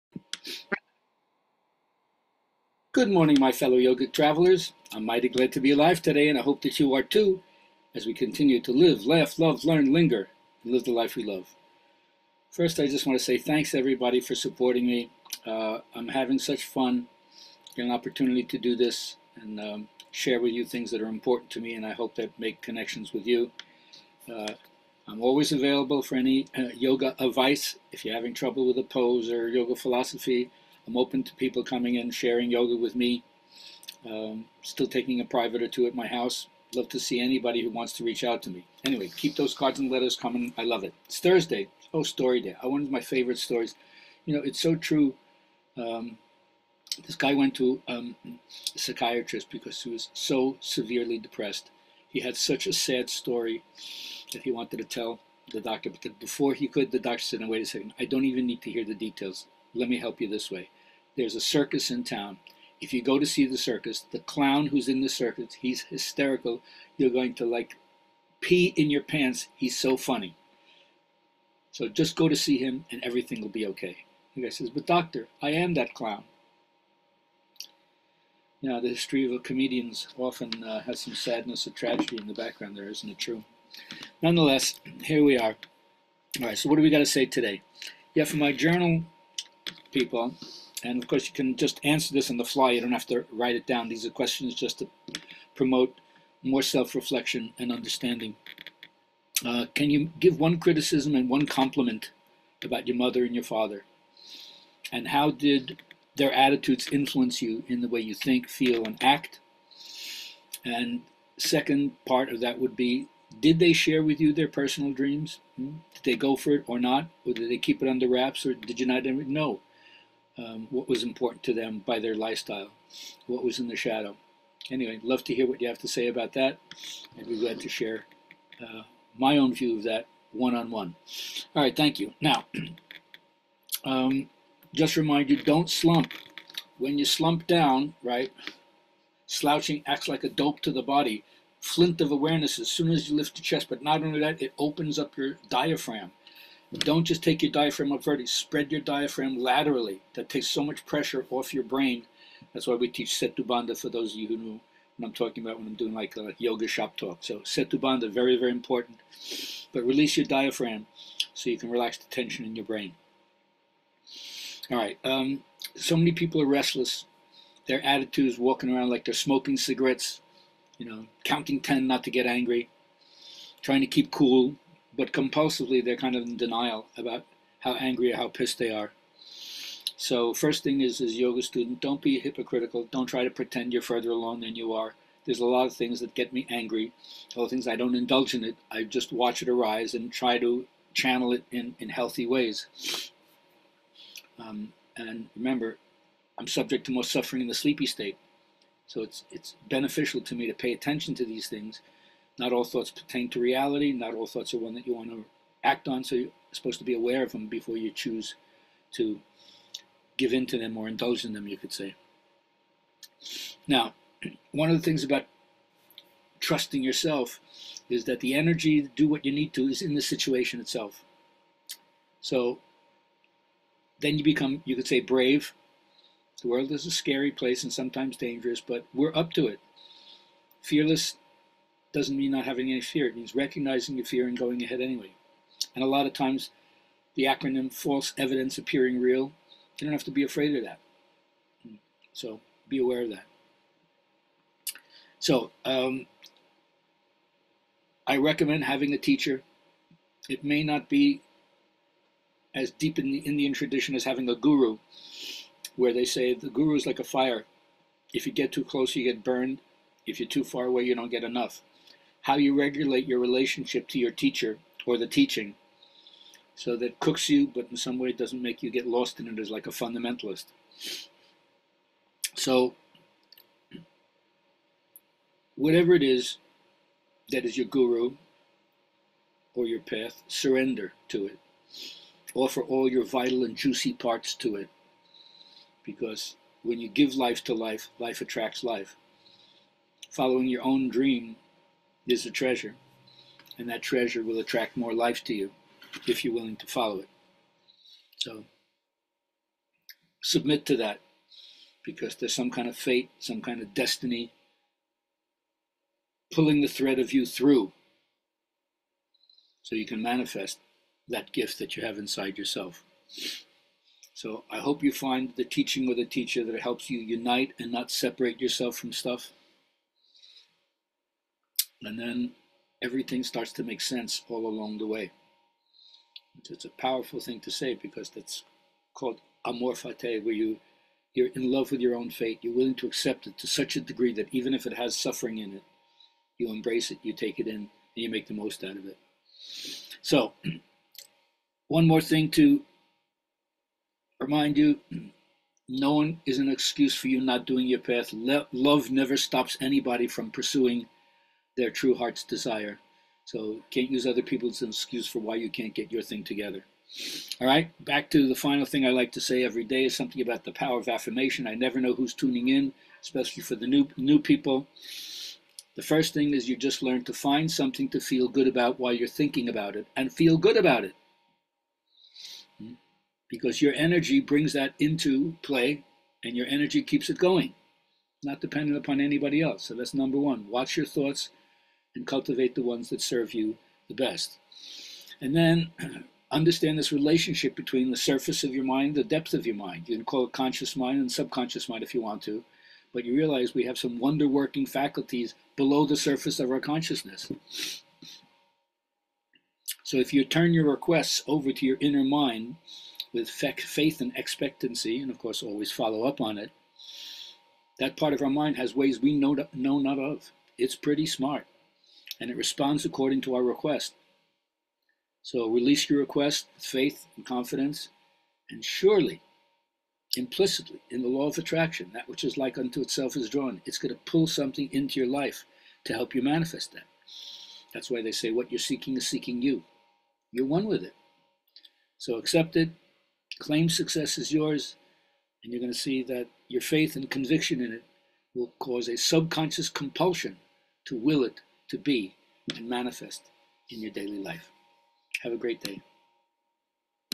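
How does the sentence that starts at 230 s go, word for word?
Fearless doesn't mean not having any fear.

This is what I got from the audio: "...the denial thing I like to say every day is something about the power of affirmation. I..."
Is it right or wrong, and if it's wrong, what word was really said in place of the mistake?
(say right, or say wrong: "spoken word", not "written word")
wrong: "final", not "denial".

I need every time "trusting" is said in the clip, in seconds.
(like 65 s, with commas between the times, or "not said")
216 s.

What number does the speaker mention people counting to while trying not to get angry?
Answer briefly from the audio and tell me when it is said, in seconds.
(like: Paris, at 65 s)
10, at 171 s.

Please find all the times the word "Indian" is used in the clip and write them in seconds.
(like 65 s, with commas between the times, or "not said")
253 s.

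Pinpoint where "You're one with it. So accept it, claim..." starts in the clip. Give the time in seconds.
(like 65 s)
430 s.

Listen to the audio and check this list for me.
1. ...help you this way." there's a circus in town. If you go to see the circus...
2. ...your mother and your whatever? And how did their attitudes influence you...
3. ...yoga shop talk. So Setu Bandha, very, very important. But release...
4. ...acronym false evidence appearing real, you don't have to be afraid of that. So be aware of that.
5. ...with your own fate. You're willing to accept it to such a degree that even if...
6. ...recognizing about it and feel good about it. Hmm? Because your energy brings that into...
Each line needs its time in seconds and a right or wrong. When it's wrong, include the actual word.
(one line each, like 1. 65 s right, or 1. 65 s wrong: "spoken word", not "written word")
1. 59 s right
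2. 102 s wrong: "father", not "whatever"
3. 156 s right
4. 237 s right
5. 331 s right
6. 369 s wrong: "thinking", not "recognizing".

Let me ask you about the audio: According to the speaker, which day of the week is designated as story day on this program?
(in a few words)
Thursday.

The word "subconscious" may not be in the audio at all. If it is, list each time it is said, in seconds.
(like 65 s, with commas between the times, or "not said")
391 s, 438 s.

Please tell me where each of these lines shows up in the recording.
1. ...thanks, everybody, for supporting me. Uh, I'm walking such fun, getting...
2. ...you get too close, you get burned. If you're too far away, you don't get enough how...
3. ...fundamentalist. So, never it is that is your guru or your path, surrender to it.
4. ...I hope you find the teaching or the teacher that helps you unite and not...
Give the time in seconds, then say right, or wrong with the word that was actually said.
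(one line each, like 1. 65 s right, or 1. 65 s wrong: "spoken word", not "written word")
1. 13 s wrong: "having", not "walking"
2. 258 s right
3. 269 s wrong: "whatever", not "never"
4. 314 s right.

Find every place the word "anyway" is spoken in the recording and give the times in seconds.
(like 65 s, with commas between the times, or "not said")
38 s, 124 s, 234 s.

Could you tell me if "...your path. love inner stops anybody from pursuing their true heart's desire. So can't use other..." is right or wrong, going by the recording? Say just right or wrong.
wrong.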